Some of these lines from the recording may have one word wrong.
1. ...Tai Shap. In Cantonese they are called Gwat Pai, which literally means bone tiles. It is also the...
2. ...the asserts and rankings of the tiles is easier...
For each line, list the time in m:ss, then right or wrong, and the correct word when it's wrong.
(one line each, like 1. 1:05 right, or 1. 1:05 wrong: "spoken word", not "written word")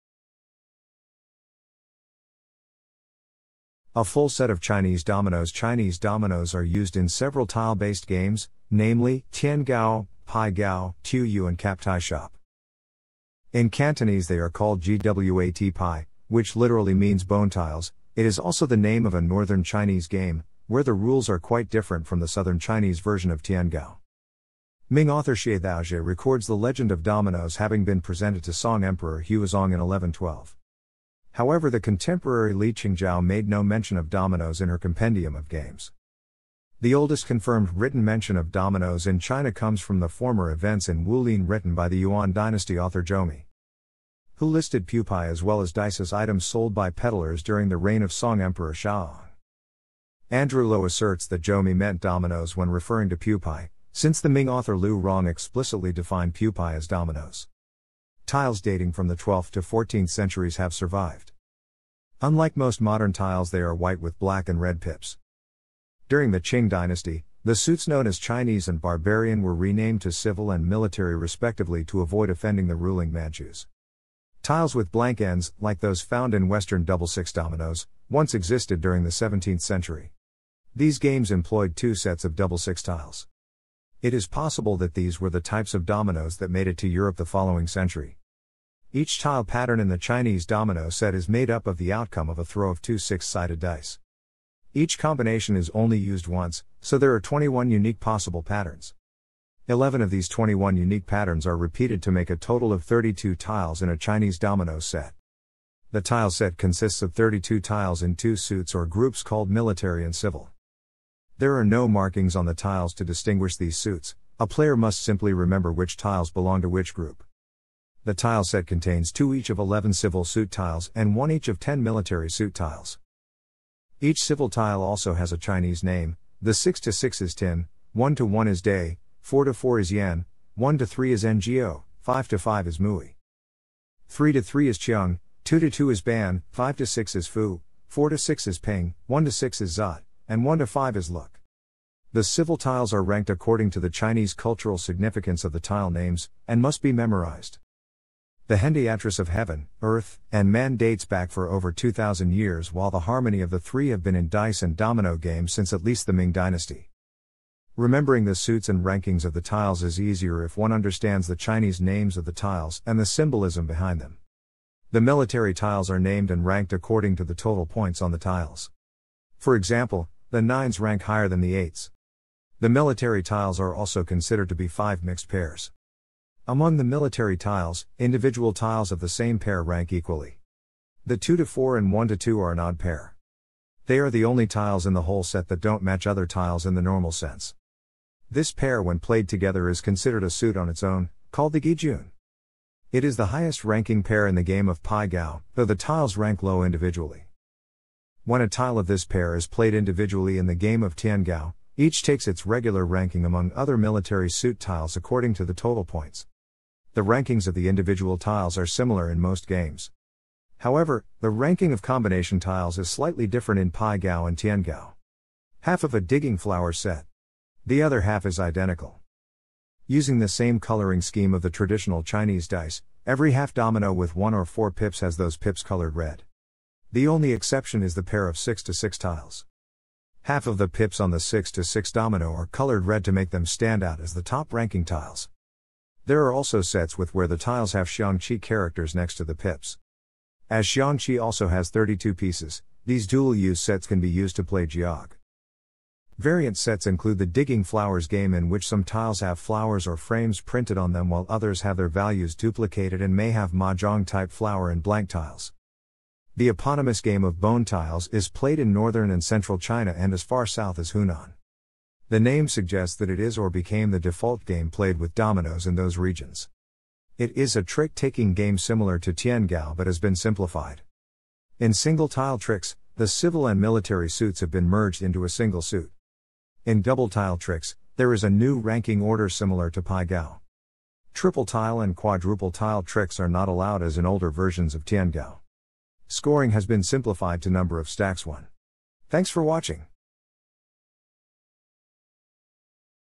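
1. 0:11 right
2. 2:38 wrong: "suits", not "asserts".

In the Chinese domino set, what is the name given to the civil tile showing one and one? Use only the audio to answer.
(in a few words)
Day.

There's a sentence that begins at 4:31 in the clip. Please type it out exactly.
In single tile tricks, the civil and military suits have been merged into a single suit.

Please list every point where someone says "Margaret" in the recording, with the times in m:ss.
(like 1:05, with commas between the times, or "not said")
not said.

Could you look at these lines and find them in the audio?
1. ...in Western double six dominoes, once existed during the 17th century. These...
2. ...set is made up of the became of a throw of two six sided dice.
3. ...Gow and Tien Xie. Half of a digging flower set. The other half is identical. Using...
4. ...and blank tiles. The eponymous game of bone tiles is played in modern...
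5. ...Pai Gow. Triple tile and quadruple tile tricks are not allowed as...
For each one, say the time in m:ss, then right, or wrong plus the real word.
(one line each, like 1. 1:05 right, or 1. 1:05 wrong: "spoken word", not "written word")
1. 1:16 right
2. 1:30 wrong: "outcome", not "became"
3. 3:33 wrong: "Gow", not "Xie"
4. 4:14 wrong: "northern", not "modern"
5. 4:39 right.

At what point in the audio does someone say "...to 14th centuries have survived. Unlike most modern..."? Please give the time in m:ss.
0:59.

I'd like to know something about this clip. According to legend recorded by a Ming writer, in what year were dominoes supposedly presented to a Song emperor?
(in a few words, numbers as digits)
1112.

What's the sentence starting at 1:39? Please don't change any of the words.
11 of these 21 unique patterns are repeated to make a total of 32 tiles in a Chinese domino set.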